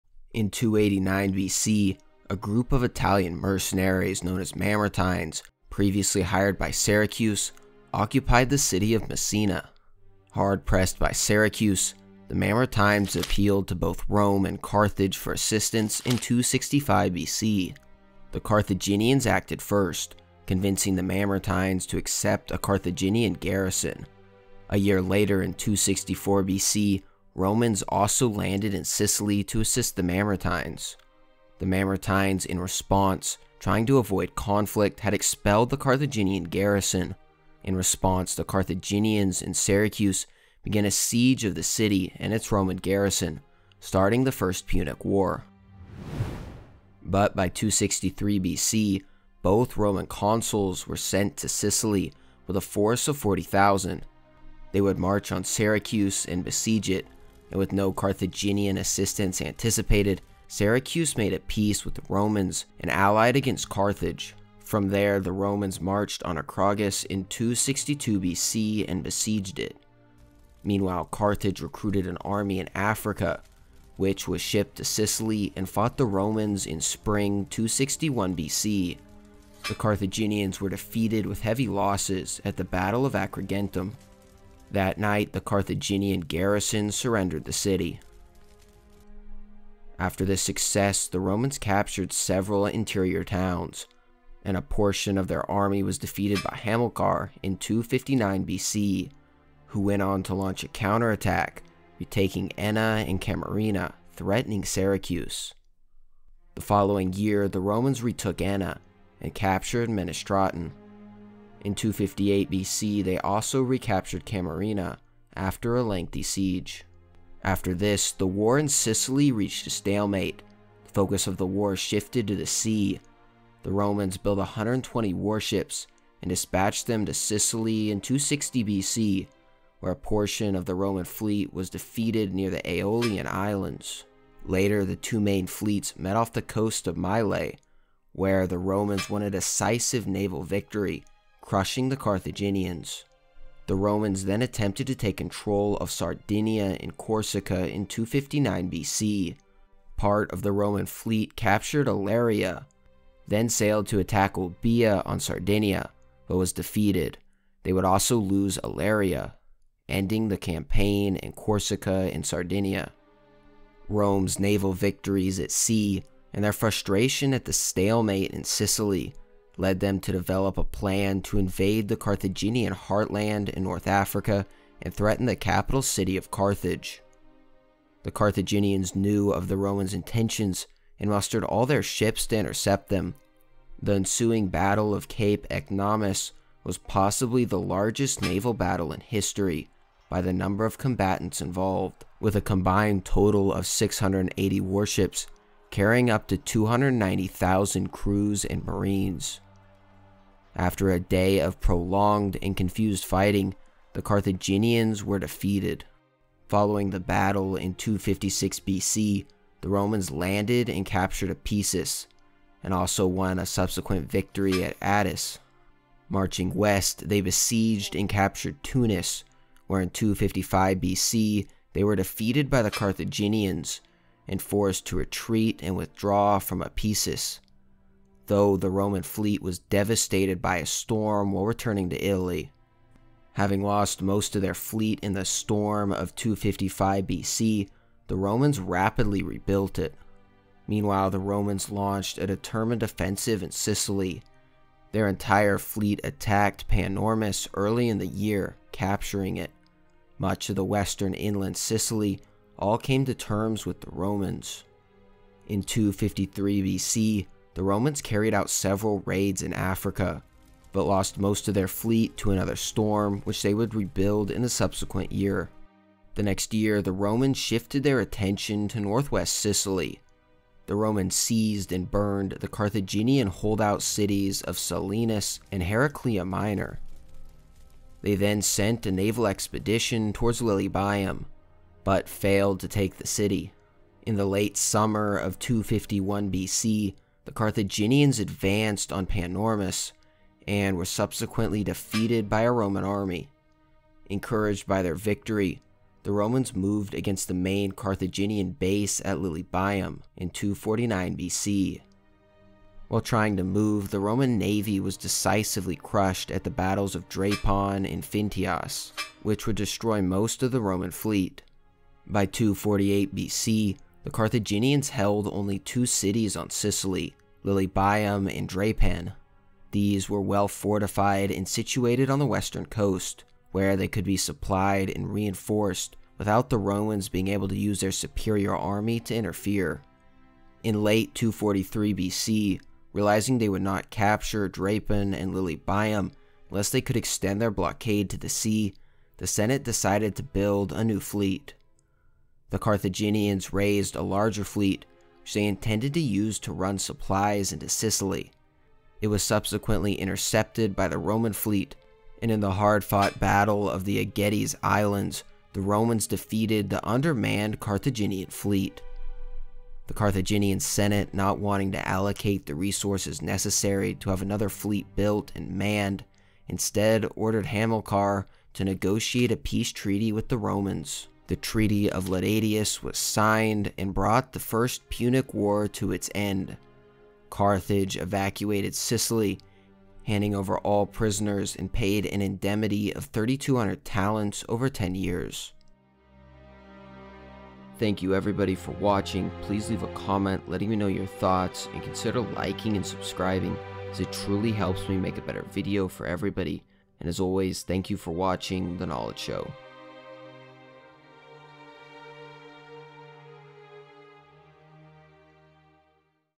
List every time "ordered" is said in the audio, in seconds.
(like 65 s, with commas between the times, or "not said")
367 s.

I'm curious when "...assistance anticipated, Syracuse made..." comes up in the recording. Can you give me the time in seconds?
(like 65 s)
58 s.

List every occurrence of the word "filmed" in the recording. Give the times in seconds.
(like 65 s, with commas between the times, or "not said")
not said.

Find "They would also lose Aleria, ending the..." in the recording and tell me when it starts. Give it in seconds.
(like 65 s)
157 s.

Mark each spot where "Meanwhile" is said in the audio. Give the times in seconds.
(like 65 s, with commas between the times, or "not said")
70 s, 240 s.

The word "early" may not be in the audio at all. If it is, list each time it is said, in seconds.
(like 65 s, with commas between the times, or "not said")
247 s.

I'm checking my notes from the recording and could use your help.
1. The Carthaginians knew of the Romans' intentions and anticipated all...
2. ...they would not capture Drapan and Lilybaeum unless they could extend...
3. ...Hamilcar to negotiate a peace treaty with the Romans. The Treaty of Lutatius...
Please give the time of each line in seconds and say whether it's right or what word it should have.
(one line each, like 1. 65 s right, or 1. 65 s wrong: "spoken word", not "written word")
1. 178 s wrong: "mustered", not "anticipated"
2. 333 s right
3. 367 s right.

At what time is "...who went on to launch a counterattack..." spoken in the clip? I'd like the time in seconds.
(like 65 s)
99 s.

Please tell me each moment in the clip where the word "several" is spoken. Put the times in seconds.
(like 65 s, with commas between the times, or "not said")
92 s, 258 s.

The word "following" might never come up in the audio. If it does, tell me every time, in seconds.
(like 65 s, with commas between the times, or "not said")
106 s, 206 s.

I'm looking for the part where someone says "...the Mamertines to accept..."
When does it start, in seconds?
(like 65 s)
20 s.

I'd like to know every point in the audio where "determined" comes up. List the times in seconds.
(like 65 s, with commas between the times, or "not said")
242 s.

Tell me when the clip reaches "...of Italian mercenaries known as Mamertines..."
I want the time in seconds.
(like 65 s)
2 s.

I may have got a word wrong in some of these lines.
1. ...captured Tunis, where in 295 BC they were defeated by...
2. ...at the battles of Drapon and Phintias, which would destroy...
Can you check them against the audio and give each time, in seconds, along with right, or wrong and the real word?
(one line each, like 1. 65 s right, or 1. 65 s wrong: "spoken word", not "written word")
1. 218 s wrong: "255", not "295"
2. 306 s right.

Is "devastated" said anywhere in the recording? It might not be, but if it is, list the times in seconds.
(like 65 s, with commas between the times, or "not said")
229 s.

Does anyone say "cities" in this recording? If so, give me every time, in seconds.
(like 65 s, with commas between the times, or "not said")
273 s, 315 s.